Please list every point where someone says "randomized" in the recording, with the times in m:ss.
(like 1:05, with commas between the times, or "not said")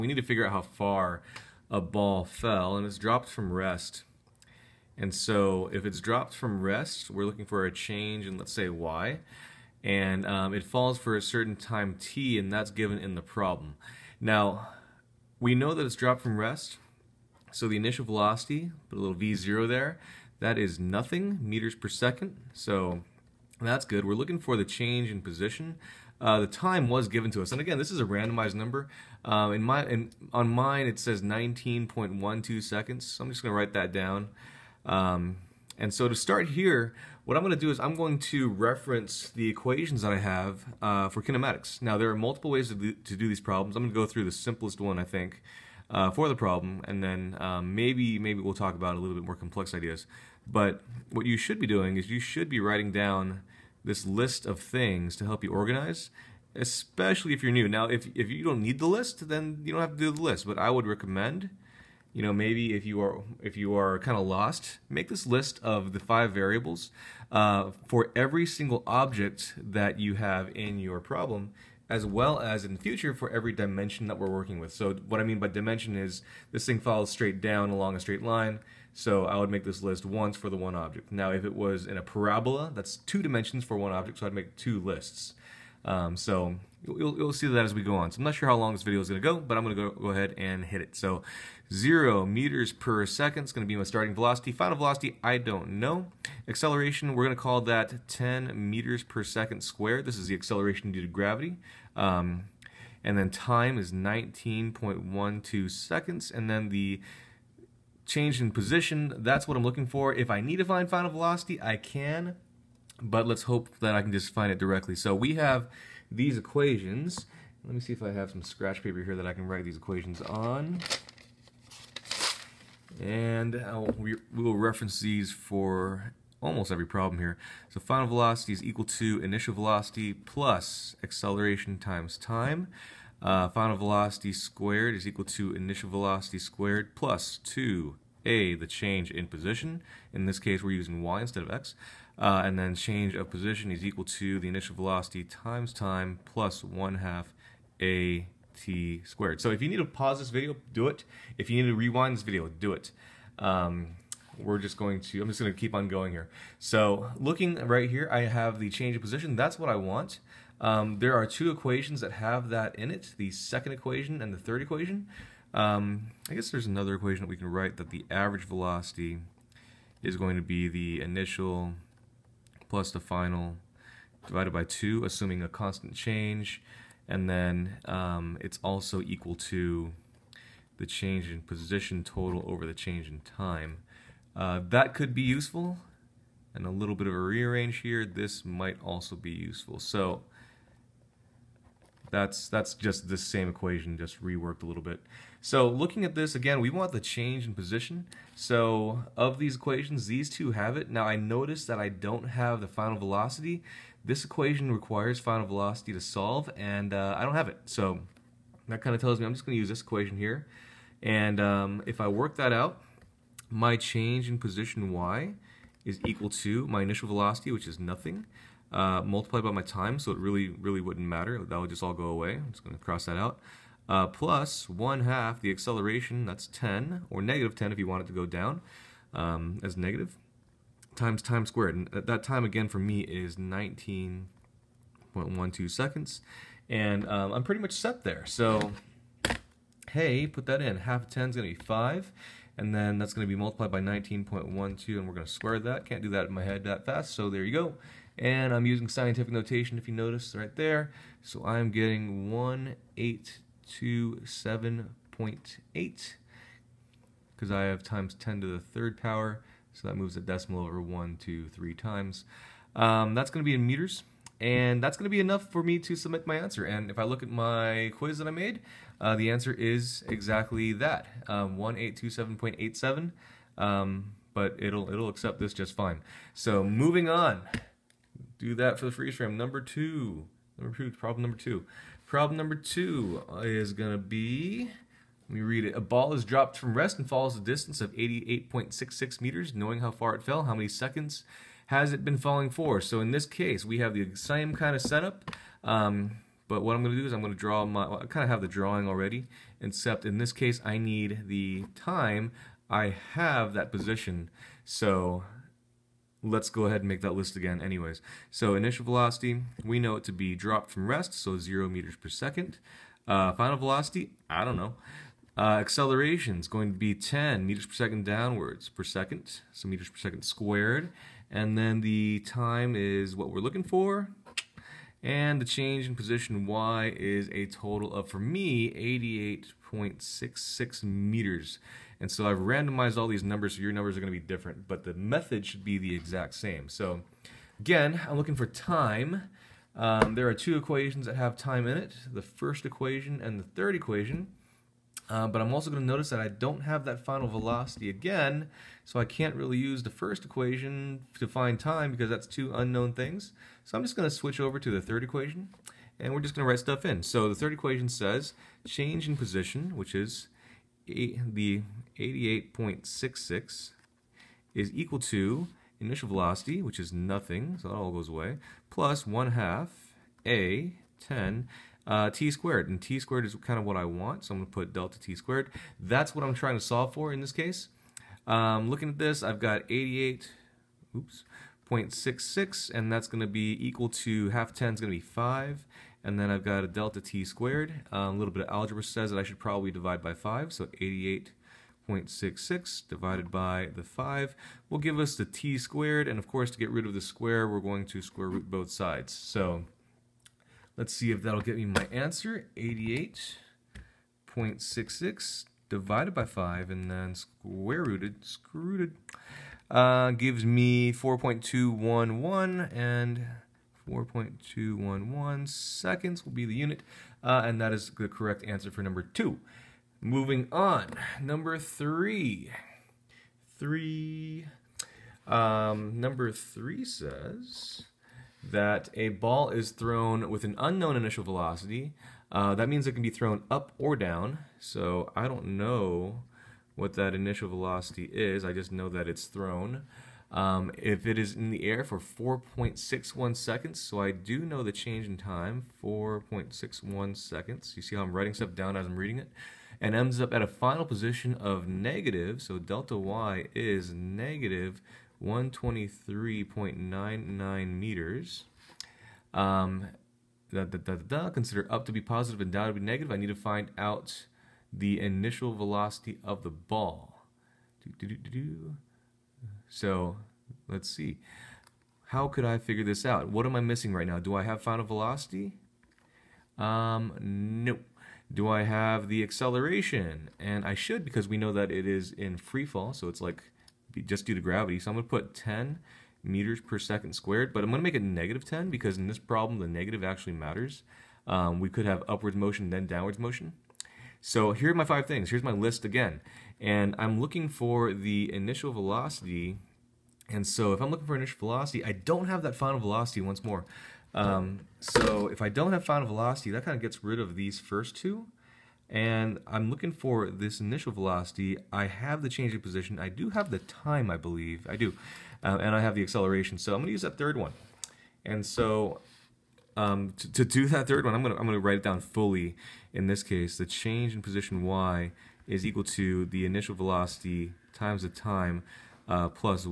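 0:28, 5:32.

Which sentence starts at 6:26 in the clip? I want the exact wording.
And then I've got a delta t squared.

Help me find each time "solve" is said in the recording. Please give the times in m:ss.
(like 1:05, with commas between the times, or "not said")
3:25, 6:16.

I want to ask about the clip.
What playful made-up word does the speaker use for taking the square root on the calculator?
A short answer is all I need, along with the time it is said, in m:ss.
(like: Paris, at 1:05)
scrooted, at 6:48.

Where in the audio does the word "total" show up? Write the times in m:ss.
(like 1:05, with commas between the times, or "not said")
3:02, 5:27.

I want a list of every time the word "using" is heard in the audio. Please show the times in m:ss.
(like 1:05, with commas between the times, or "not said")
2:20, 4:08.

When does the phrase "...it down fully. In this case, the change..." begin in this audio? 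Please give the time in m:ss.
8:41.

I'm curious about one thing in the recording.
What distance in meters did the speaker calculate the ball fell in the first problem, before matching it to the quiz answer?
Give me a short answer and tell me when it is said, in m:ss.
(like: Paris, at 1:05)
1827.8, at 4:12.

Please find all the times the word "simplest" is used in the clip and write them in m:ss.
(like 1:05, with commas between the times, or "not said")
0:44.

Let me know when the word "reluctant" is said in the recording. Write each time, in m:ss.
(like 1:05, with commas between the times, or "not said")
not said.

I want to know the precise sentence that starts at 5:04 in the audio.
So let's go ahead and make that list again anyways.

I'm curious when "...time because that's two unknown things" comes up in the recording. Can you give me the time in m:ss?
5:51.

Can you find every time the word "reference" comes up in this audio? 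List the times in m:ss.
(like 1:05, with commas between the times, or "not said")
0:38, 2:04.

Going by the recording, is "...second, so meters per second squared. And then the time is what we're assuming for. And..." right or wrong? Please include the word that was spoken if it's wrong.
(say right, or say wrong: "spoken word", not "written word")
wrong: "looking", not "assuming".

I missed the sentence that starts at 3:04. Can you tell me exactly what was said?
Uh, that could be useful, and a little bit of a rearrange here, this might also be useful.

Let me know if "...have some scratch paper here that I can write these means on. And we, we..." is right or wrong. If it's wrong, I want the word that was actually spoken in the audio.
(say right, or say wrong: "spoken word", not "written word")
wrong: "equations", not "means".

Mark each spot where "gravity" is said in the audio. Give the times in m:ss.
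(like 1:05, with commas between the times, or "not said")
1:41, 8:04.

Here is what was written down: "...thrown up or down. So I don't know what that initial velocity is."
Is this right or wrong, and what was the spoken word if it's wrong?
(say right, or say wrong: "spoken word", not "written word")
right.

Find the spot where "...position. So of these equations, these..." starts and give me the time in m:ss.
3:17.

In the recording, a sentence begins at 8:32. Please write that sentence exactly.
I do have the time, I believe.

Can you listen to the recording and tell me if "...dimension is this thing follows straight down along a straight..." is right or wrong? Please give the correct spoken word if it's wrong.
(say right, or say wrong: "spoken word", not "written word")
right.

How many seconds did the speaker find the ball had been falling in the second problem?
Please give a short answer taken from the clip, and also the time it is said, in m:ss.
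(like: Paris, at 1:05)
4.211 seconds, at 6:53.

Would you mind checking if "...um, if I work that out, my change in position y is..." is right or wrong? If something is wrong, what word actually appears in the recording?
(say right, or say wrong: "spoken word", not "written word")
right.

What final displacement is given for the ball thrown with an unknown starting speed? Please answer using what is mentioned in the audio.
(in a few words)
-123.99 meters.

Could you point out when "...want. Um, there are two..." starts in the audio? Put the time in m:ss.
2:39.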